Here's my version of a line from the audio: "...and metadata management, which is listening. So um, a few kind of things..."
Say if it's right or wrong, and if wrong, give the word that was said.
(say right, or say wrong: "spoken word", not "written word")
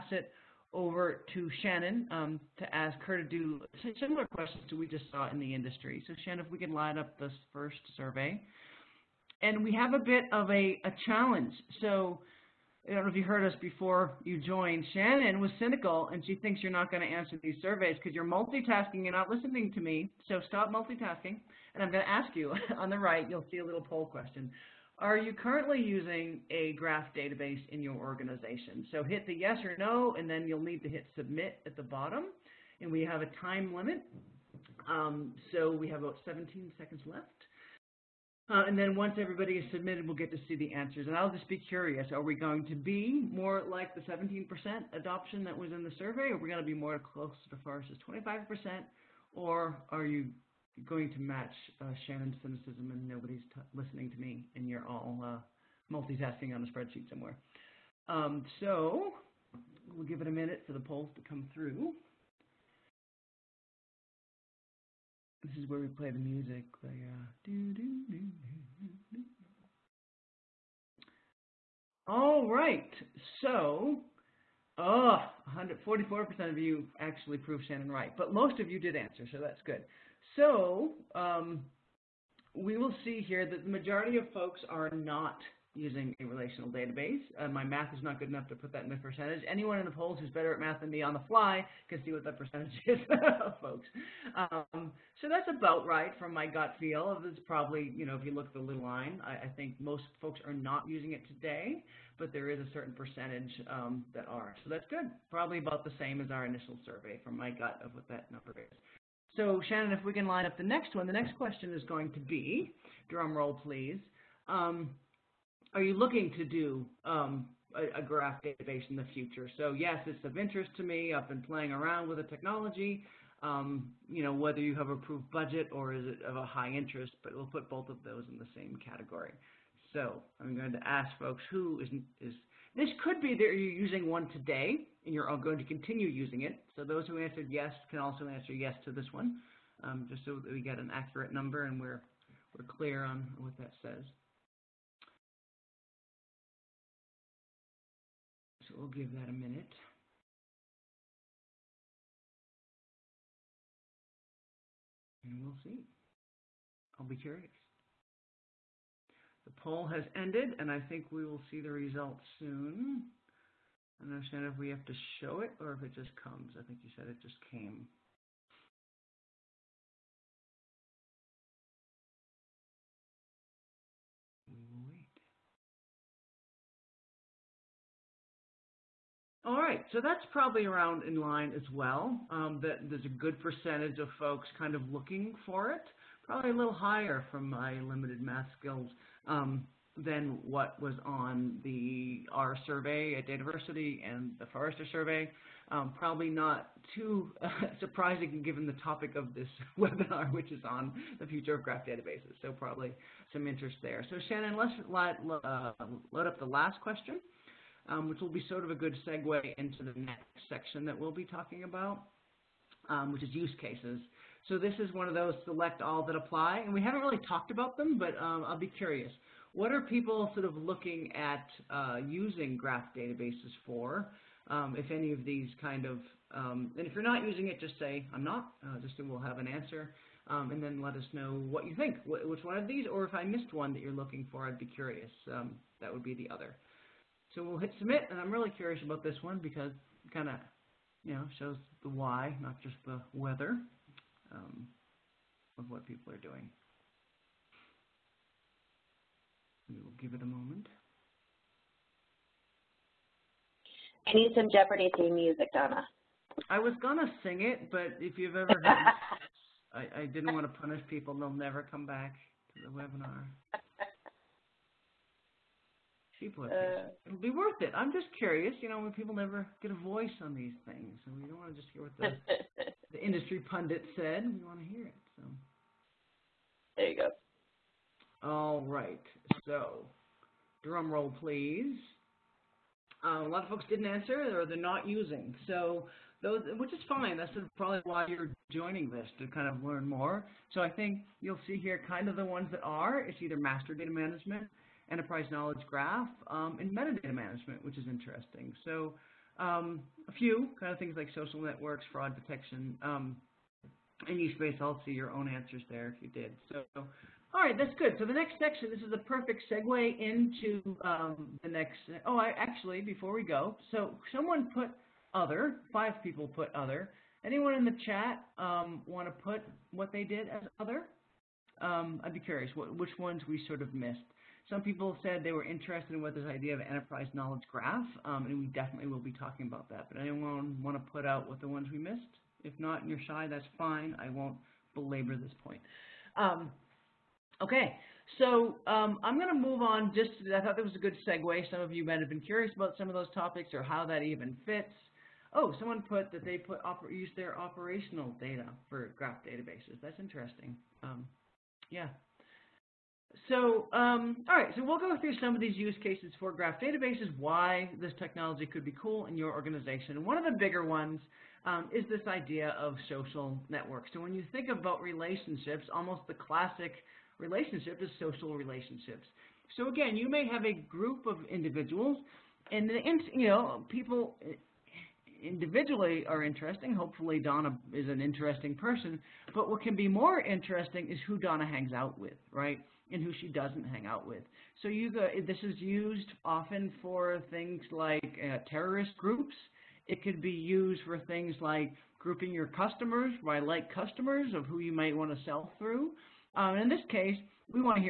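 wrong: "interesting", not "listening".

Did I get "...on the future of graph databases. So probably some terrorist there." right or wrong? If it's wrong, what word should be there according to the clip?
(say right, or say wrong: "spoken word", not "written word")
wrong: "interest", not "terrorist".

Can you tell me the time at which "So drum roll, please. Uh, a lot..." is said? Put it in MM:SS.
04:39.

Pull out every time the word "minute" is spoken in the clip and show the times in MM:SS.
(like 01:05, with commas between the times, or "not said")
01:00, 02:29.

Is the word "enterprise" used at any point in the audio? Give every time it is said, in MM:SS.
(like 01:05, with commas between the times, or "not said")
04:54, 05:26.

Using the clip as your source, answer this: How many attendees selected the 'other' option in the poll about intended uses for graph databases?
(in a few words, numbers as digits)
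5.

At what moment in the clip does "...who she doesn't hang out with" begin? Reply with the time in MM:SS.
06:23.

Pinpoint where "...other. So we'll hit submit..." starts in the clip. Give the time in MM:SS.
03:56.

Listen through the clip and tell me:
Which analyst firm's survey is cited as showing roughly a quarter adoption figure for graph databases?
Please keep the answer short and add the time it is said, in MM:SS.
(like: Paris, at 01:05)
Forrester, at 00:47.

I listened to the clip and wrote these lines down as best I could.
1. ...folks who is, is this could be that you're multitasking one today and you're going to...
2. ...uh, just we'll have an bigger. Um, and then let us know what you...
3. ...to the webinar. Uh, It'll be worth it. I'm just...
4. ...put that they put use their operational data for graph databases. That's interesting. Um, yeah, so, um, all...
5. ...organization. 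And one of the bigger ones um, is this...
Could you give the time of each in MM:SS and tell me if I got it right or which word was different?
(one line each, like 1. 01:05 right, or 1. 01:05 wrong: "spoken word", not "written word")
1. 02:11 wrong: "using", not "multitasking"
2. 03:48 wrong: "answer", not "bigger"
3. 04:22 right
4. 05:45 right
5. 05:59 right.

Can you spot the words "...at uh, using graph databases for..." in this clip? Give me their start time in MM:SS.
03:41.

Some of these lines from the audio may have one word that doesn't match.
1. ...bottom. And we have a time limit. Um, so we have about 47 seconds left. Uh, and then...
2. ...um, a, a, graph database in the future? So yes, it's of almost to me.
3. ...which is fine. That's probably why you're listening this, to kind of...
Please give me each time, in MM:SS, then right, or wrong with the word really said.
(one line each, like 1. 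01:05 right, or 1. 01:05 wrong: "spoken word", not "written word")
1. 00:31 wrong: "17", not "47"
2. 01:57 wrong: "interest", not "almost"
3. 04:46 wrong: "joining", not "listening".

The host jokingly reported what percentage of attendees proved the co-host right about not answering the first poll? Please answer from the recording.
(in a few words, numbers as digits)
144%.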